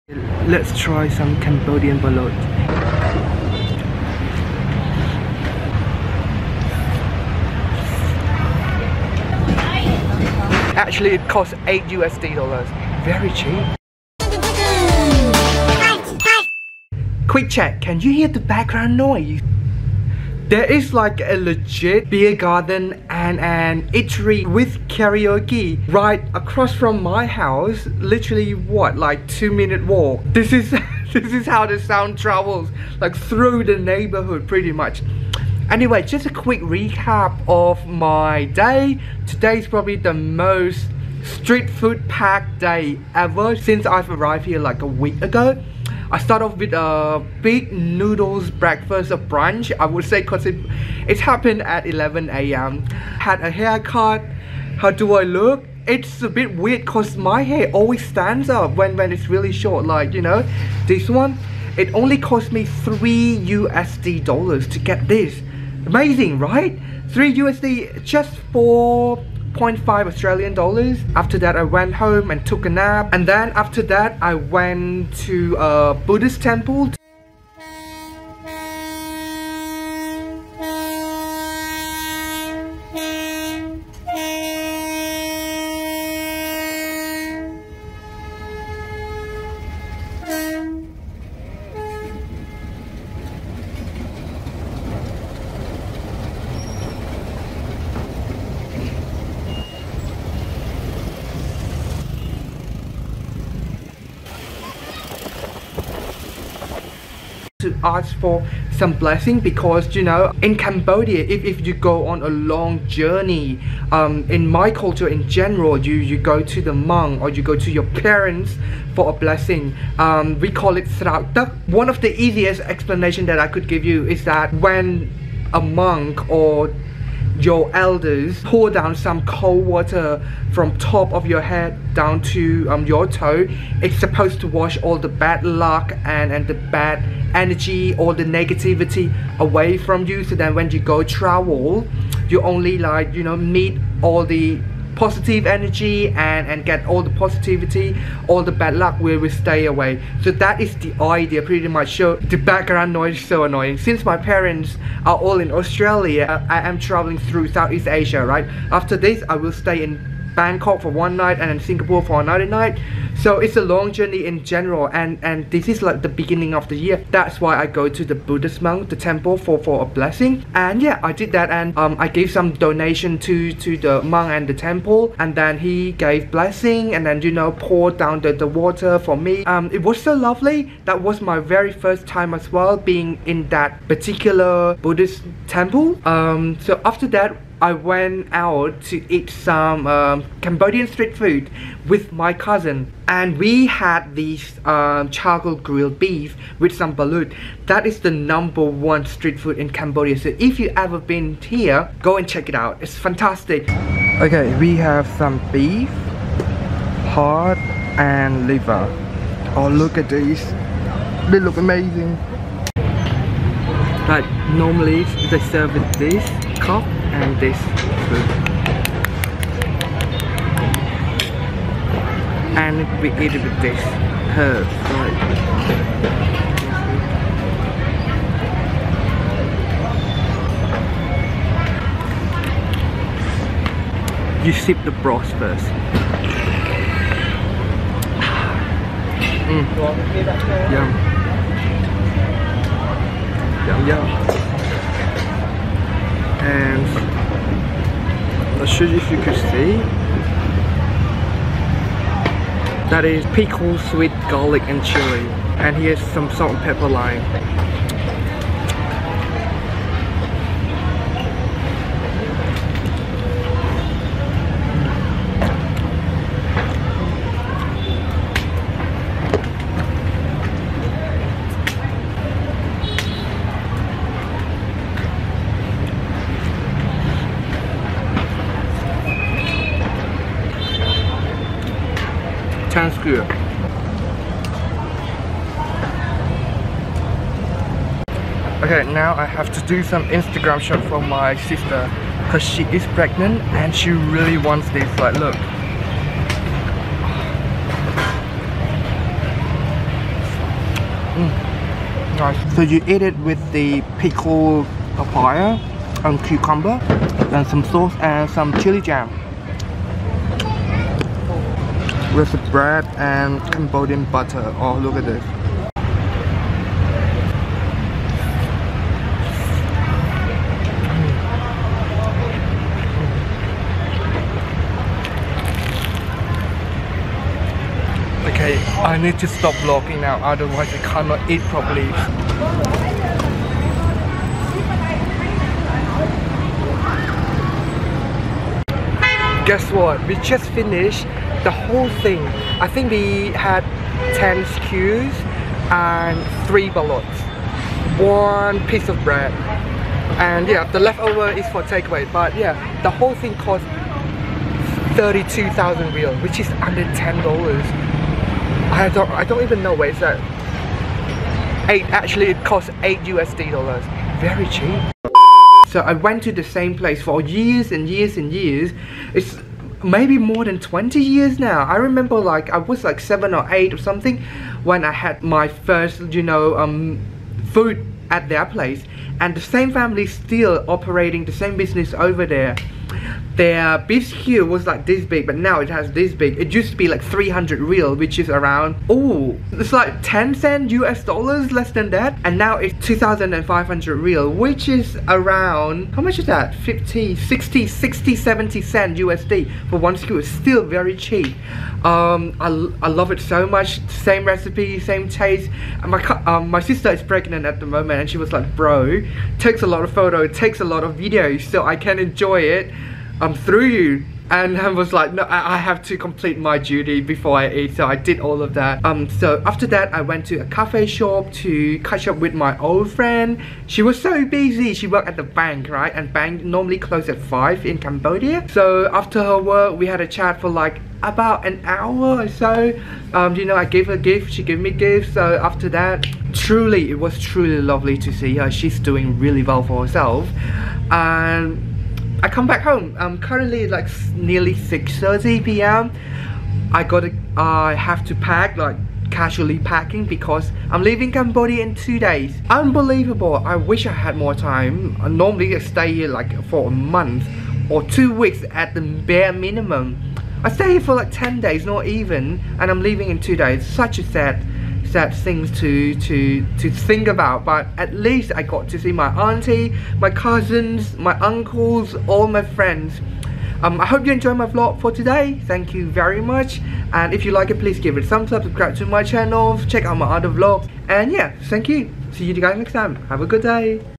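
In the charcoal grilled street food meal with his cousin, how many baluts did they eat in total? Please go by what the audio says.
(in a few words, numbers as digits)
3.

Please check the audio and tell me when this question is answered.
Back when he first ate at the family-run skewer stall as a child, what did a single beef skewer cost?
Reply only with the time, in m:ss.
6:27.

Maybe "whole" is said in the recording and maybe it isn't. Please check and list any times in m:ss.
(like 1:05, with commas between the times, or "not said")
5:41, 5:52.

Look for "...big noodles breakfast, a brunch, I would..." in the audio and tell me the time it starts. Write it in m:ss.
0:47.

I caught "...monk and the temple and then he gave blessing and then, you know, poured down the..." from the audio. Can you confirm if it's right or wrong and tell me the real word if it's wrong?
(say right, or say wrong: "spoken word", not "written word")
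right.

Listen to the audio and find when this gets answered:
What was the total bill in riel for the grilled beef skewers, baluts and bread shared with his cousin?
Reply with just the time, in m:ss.
5:54.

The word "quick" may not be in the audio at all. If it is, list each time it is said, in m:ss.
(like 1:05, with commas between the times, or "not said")
0:17, 0:36.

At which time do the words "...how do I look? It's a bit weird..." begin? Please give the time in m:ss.
0:54.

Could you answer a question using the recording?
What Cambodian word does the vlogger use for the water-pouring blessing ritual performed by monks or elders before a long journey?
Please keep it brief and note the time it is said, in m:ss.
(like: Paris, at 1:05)
Srao, at 2:00.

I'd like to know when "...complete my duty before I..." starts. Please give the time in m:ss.
6:55.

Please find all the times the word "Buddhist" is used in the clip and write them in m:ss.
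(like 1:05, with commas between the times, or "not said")
1:15, 2:48, 3:04.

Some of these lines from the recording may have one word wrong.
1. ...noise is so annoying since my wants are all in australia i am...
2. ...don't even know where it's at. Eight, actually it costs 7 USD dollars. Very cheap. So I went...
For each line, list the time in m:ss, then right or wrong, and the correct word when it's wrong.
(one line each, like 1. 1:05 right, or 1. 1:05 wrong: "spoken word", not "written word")
1. 2:32 wrong: "parents", not "wants"
2. 5:59 wrong: "8", not "7".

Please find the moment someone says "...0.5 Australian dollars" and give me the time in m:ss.
1:09.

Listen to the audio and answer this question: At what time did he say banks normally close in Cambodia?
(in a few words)
5.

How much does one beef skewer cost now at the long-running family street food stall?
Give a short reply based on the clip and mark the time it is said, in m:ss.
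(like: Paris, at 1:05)
2500 riel, at 6:32.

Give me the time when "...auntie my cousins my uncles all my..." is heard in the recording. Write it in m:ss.
7:49.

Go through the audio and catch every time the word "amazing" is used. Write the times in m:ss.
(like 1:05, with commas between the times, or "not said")
1:05, 3:31.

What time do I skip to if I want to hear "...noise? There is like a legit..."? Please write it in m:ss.
0:18.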